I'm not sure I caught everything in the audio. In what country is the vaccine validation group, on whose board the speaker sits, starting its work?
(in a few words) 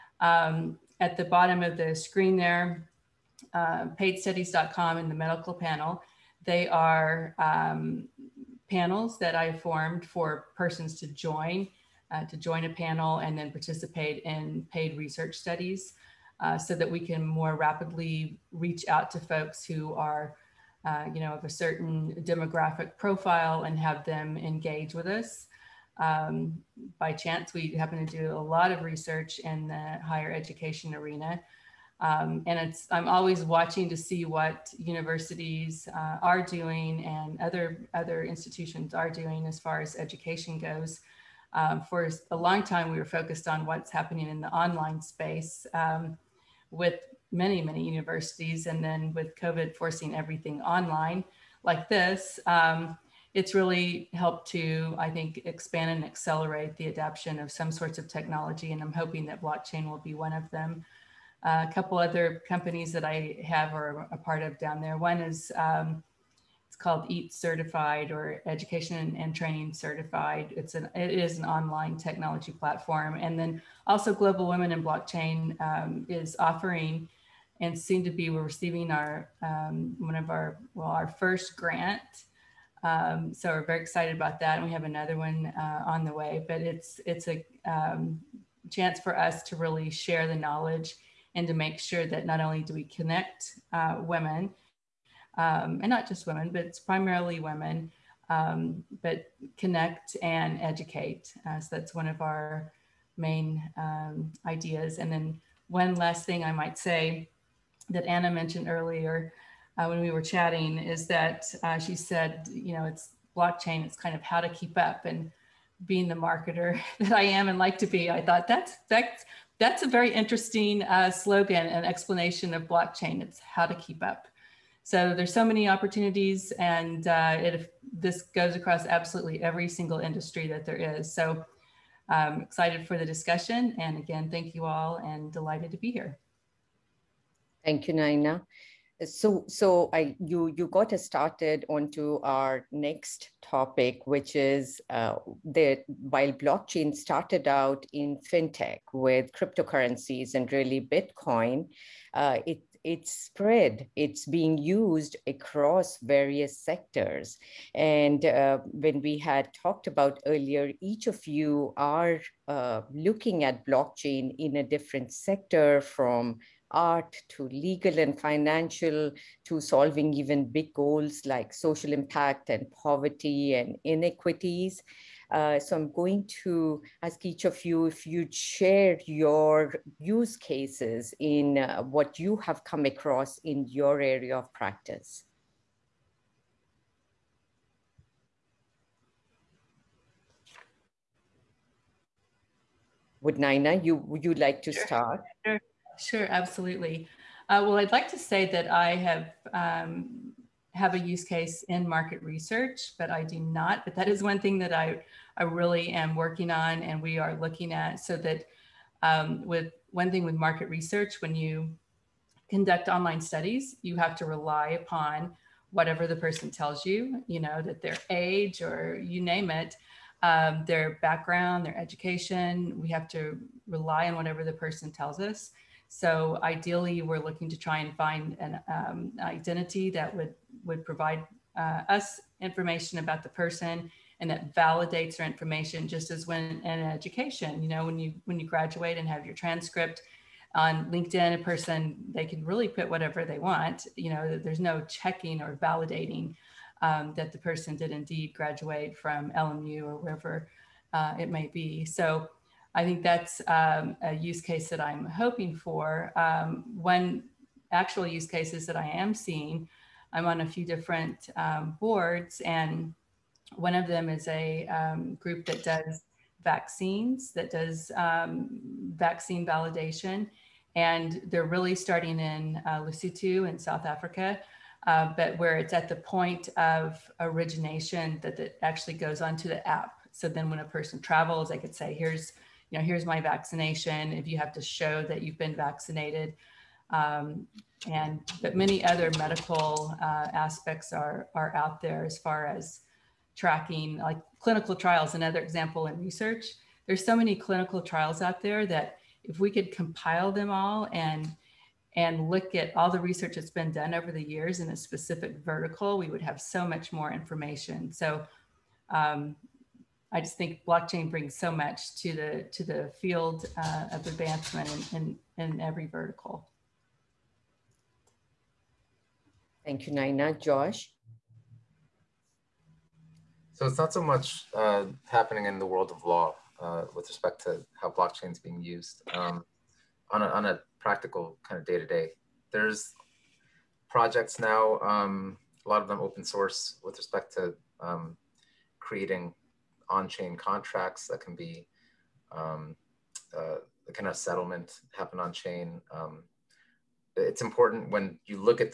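Lesotho.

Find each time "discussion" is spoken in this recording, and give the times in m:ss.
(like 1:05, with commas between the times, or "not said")
2:13.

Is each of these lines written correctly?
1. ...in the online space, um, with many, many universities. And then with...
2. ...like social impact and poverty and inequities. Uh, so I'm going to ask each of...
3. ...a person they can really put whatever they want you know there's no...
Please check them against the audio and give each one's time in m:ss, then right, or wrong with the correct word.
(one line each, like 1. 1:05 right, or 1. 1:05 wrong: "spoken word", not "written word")
1. 0:44 right
2. 2:51 right
3. 4:01 right.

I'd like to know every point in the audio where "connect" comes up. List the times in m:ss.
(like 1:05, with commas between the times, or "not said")
1:32, 1:39.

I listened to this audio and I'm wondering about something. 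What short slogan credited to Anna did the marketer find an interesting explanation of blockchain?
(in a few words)
It's how to keep up.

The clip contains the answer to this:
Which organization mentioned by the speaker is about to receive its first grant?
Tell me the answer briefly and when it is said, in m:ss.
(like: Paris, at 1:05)
Global Women in Blockchain, at 1:14.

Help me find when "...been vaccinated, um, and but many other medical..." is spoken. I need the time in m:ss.
4:45.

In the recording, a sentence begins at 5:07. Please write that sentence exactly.
So um, I just think blockchain brings so much to the to the field uh, of advancement in, in, in every vertical.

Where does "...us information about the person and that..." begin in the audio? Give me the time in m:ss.
3:51.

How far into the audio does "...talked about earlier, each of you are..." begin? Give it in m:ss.
2:39.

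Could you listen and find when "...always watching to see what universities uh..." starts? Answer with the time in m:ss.
0:33.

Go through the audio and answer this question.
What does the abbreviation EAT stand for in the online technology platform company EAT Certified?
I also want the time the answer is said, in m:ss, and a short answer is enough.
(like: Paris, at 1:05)
Education and Training Certified, at 1:08.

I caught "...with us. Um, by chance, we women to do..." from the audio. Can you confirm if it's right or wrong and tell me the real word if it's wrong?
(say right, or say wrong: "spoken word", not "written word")
wrong: "happen", not "women".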